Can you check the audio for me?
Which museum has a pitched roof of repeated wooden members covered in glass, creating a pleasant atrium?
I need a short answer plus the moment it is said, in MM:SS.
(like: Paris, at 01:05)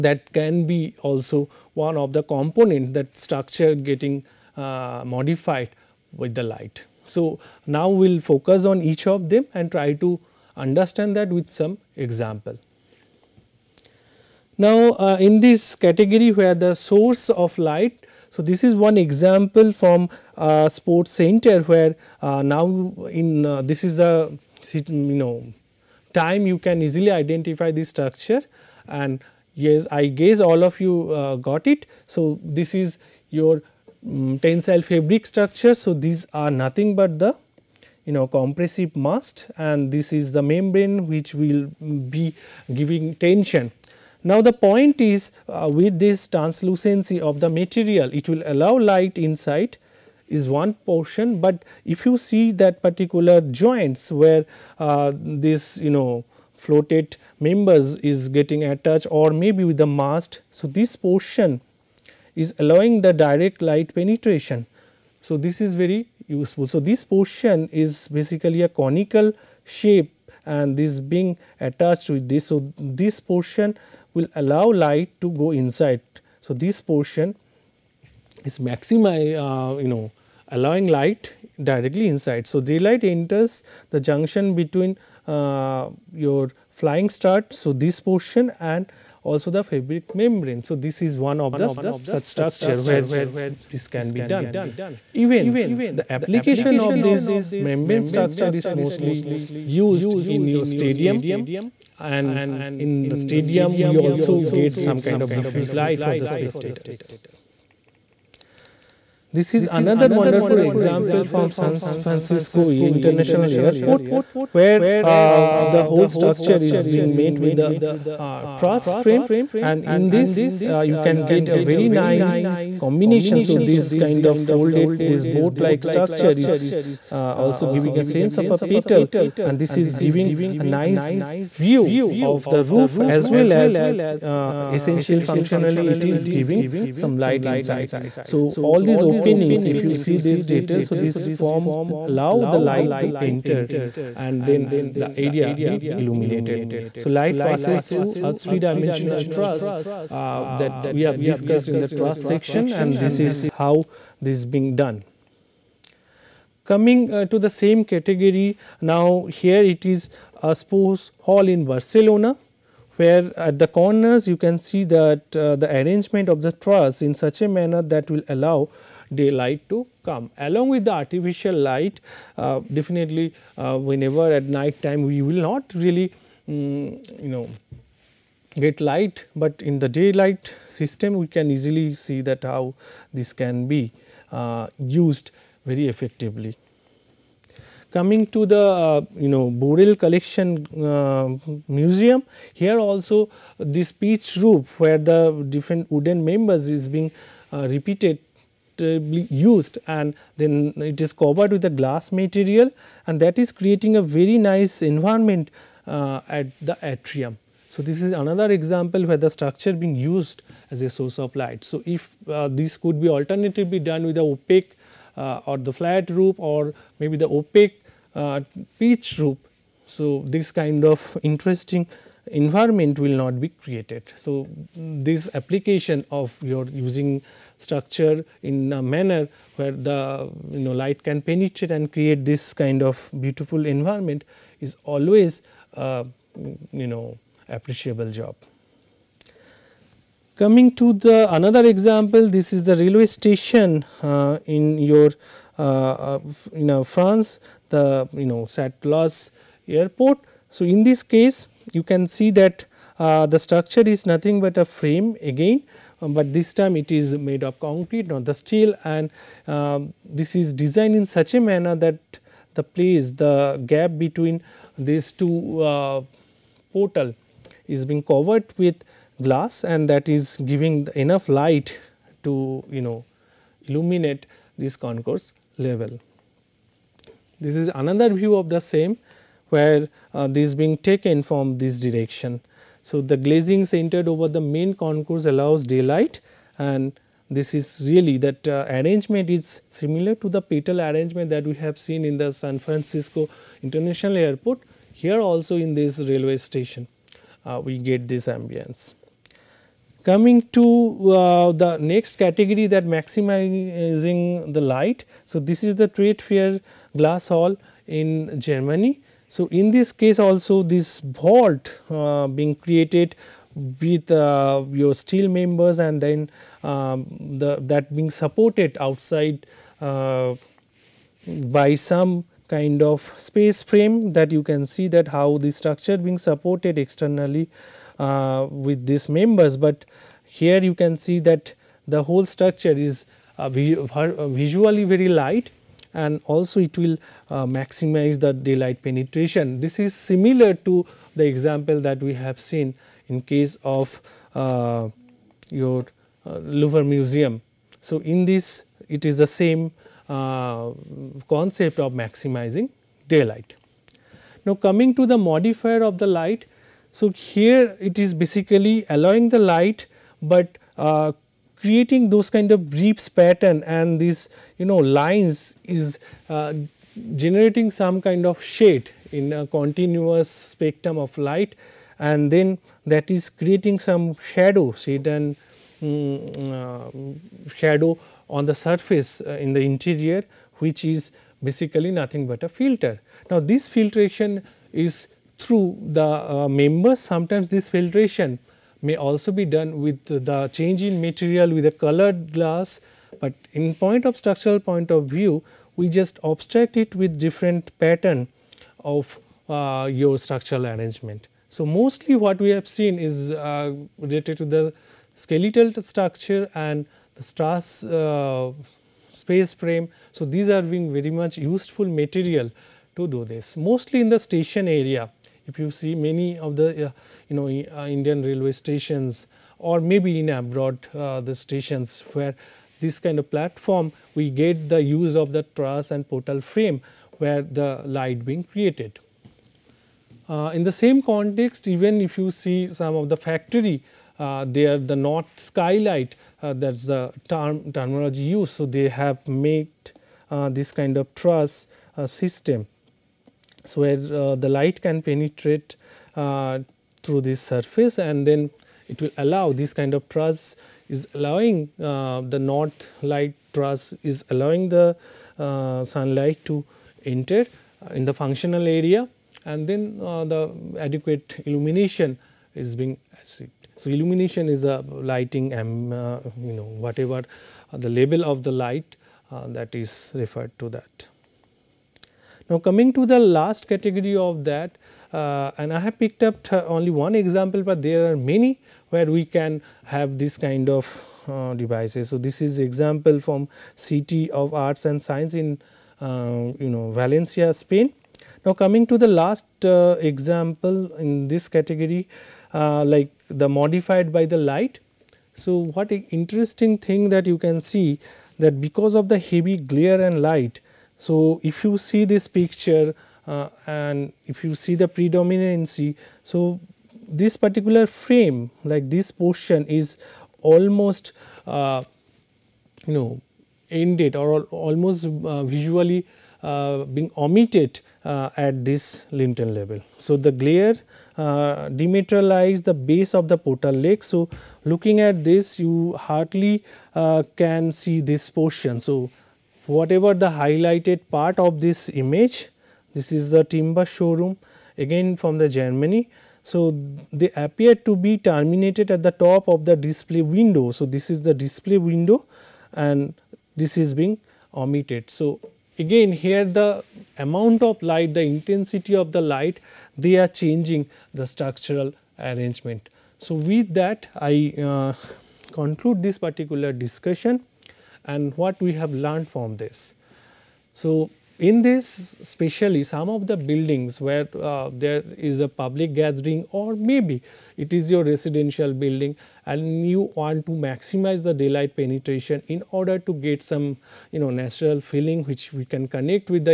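Burrell Collection, at 03:09.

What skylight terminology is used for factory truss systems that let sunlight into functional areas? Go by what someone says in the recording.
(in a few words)
North skylight.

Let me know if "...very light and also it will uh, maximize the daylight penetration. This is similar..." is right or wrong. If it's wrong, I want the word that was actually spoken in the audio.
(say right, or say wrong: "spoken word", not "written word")
right.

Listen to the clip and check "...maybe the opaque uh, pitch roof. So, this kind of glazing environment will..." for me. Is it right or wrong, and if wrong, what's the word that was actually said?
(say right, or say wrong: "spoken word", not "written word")
wrong: "interesting", not "glazing".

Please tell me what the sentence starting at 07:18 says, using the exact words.
So, they have made uh, this kind of truss system.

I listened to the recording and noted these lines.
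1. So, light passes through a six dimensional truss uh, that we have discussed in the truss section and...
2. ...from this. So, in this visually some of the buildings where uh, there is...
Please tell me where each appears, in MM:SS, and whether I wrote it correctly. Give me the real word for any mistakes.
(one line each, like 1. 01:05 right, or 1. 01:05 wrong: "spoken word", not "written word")
1. 02:26 wrong: "three", not "six"
2. 09:19 wrong: "especially", not "visually".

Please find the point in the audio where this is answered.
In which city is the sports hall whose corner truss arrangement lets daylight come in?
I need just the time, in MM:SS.
02:41.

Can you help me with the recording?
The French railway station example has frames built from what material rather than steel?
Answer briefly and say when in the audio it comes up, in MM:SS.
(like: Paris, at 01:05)
Concrete, at 04:17.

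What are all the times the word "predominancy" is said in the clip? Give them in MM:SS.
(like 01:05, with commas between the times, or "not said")
08:24.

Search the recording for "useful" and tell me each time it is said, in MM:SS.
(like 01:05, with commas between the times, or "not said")
01:06, 06:51.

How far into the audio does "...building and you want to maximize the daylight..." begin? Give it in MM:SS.
09:28.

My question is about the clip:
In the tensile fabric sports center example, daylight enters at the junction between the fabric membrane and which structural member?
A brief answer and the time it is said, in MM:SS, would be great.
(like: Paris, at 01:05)
Flying strut, at 01:26.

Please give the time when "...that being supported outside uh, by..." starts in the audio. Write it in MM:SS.
05:17.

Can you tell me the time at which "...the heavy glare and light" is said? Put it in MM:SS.
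08:19.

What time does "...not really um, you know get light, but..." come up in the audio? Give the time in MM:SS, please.
02:55.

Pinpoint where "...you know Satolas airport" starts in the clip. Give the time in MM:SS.
04:08.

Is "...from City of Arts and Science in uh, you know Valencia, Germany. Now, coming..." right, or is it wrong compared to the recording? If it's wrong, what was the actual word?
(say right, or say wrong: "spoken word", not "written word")
wrong: "Spain", not "Germany".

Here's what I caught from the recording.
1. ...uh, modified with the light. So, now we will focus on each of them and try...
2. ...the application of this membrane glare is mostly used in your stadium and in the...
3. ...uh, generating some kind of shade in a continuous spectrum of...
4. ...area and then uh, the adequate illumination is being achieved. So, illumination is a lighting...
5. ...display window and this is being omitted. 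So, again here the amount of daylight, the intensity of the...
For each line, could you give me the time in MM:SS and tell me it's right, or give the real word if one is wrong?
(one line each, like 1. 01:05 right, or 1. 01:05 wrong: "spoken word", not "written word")
1. 00:04 right
2. 01:35 wrong: "structure", not "glare"
3. 06:06 right
4. 07:38 right
5. 09:01 wrong: "light", not "daylight".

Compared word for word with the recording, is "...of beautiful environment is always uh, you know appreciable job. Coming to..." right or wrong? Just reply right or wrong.
right.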